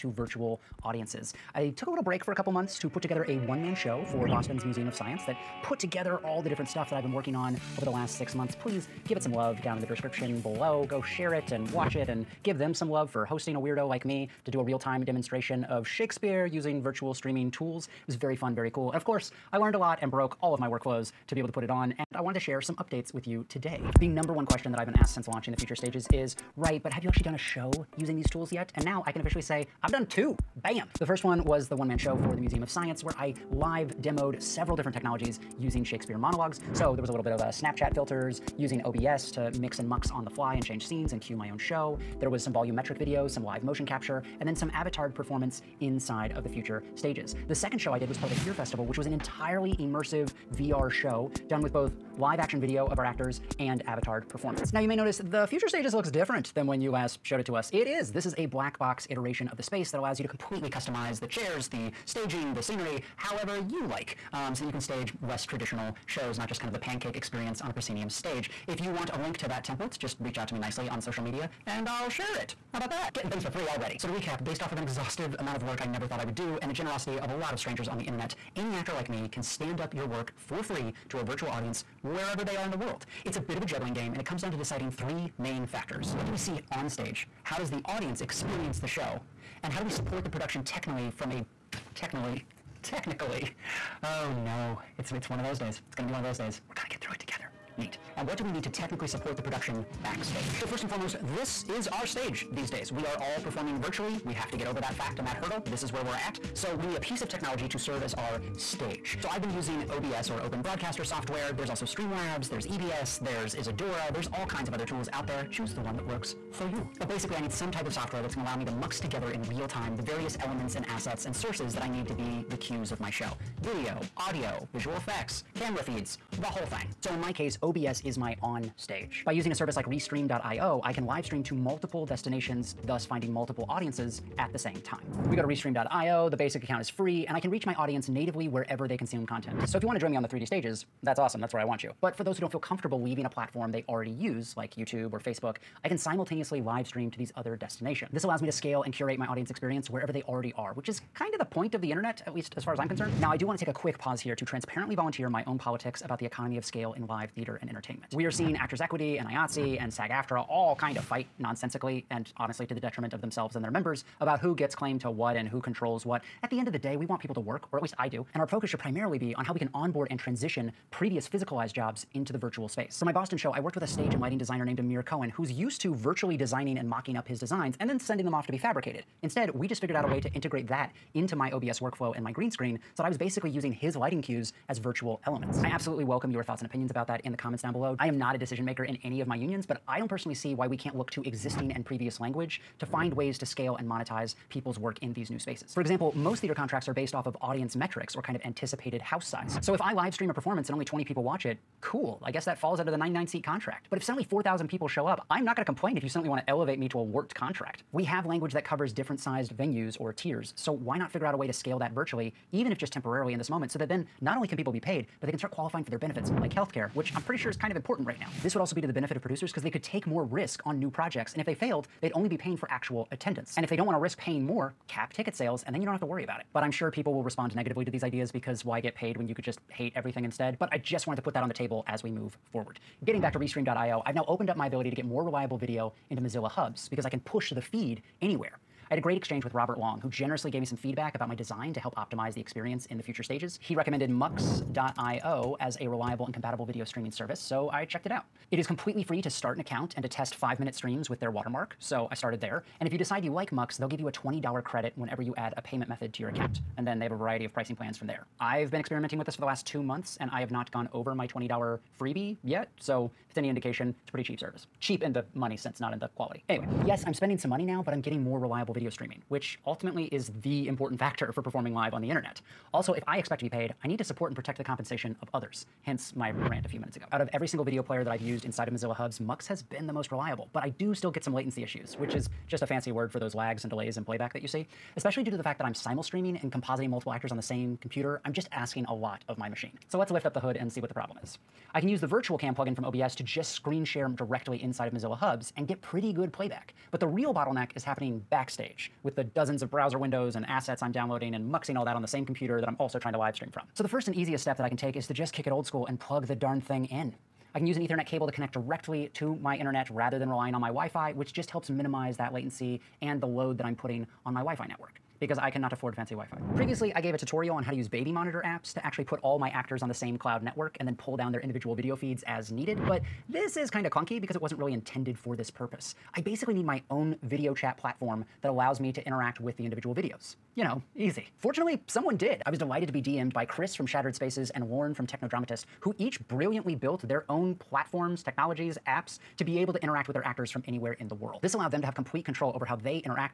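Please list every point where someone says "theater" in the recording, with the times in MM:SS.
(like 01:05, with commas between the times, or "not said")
02:37, 03:16.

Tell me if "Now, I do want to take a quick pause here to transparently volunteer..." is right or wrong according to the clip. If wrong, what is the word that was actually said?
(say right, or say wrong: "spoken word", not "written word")
right.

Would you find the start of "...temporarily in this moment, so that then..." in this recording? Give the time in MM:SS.
03:32.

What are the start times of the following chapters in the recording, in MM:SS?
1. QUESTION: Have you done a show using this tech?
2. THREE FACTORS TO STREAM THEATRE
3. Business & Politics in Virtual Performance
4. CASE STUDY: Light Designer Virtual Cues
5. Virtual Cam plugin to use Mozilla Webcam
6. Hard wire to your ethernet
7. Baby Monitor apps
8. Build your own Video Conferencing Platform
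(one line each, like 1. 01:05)
1. 00:26
2. 01:24
3. 02:29
4. 02:54
5. 04:51
6. 05:03
7. 05:16
8. 05:25.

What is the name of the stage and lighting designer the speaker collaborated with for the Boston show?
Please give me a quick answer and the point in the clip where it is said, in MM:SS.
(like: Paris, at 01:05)
Amir Cohen, at 02:54.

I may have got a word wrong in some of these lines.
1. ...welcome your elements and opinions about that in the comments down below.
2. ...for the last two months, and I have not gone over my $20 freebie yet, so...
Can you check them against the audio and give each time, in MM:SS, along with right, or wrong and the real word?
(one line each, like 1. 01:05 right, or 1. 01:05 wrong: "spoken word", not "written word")
1. 03:06 wrong: "thoughts", not "elements"
2. 04:19 right.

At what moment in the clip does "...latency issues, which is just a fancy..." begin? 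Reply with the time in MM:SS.
04:41.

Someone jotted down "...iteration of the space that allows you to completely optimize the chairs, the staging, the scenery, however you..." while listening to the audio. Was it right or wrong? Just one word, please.
wrong.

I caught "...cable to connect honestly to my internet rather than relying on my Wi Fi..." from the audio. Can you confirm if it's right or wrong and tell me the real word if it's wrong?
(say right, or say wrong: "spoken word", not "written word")
wrong: "directly", not "honestly".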